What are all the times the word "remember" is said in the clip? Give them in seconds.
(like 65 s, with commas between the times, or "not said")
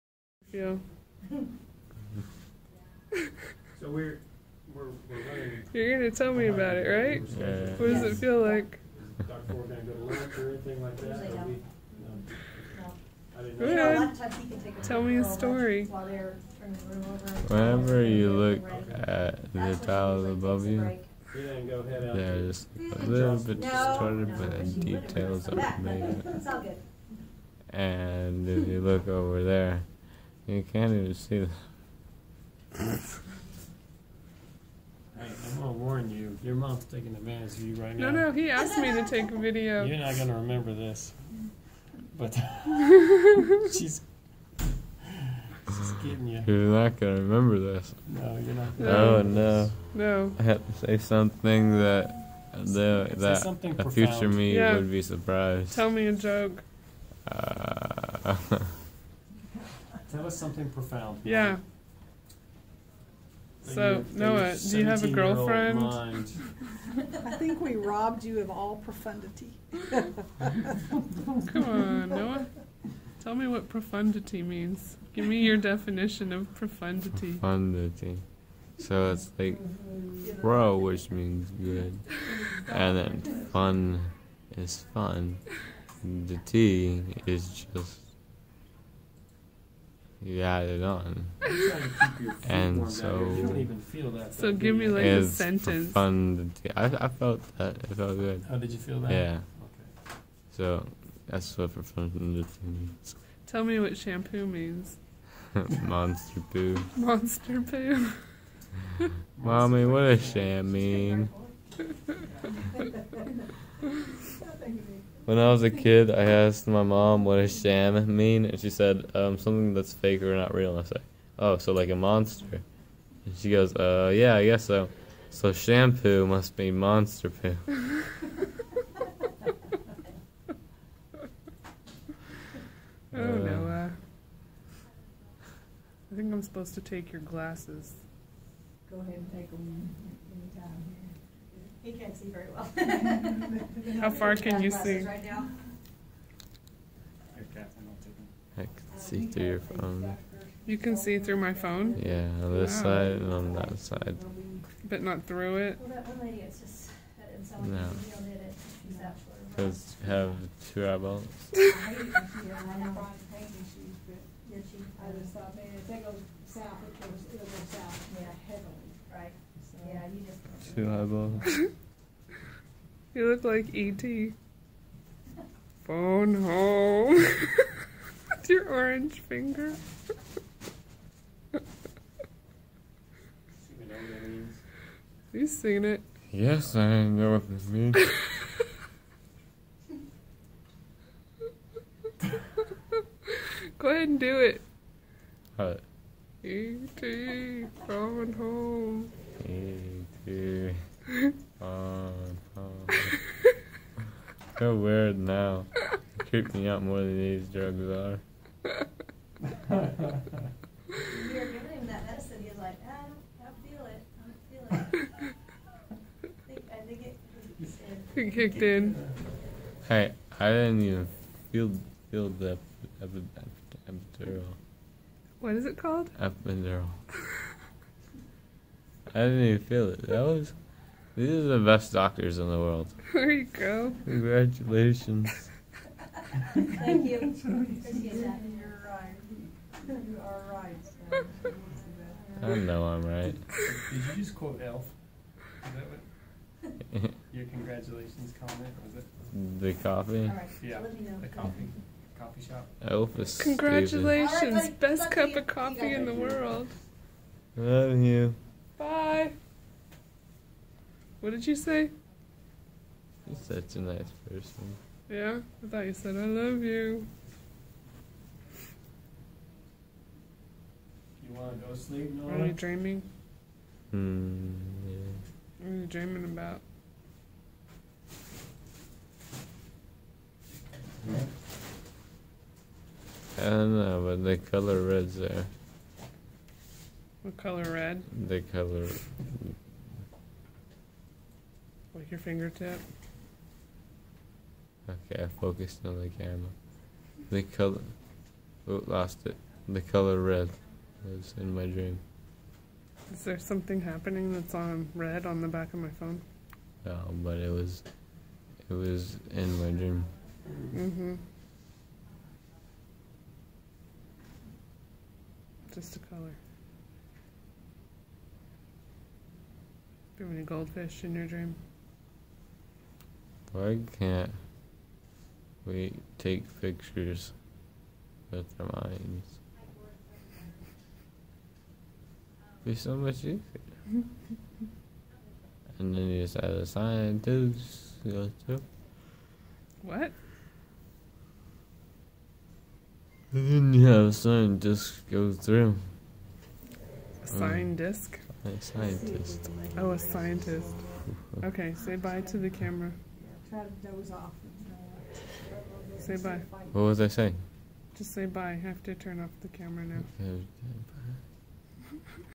40 s, 47 s.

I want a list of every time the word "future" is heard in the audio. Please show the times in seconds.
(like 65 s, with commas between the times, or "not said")
53 s.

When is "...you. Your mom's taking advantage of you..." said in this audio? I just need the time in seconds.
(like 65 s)
36 s.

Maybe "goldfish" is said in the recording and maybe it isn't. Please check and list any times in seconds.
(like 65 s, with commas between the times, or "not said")
320 s.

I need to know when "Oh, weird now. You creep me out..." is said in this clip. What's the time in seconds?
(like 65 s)
204 s.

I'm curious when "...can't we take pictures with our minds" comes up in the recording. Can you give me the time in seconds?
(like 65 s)
323 s.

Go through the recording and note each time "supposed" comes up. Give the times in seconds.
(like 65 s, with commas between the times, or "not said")
136 s.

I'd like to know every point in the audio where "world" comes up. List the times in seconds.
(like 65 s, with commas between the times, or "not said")
232 s, 256 s.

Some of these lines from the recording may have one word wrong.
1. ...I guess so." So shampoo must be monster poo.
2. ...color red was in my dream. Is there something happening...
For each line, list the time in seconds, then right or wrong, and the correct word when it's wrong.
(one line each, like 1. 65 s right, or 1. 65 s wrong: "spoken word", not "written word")
1. 124 s right
2. 299 s right.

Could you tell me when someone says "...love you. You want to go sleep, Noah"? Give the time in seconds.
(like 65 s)
266 s.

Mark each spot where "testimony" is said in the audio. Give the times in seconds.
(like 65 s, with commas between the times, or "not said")
not said.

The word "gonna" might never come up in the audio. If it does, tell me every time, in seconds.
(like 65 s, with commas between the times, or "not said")
35 s, 40 s, 46 s.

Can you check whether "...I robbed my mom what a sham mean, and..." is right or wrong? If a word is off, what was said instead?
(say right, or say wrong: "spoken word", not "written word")
wrong: "asked", not "robbed".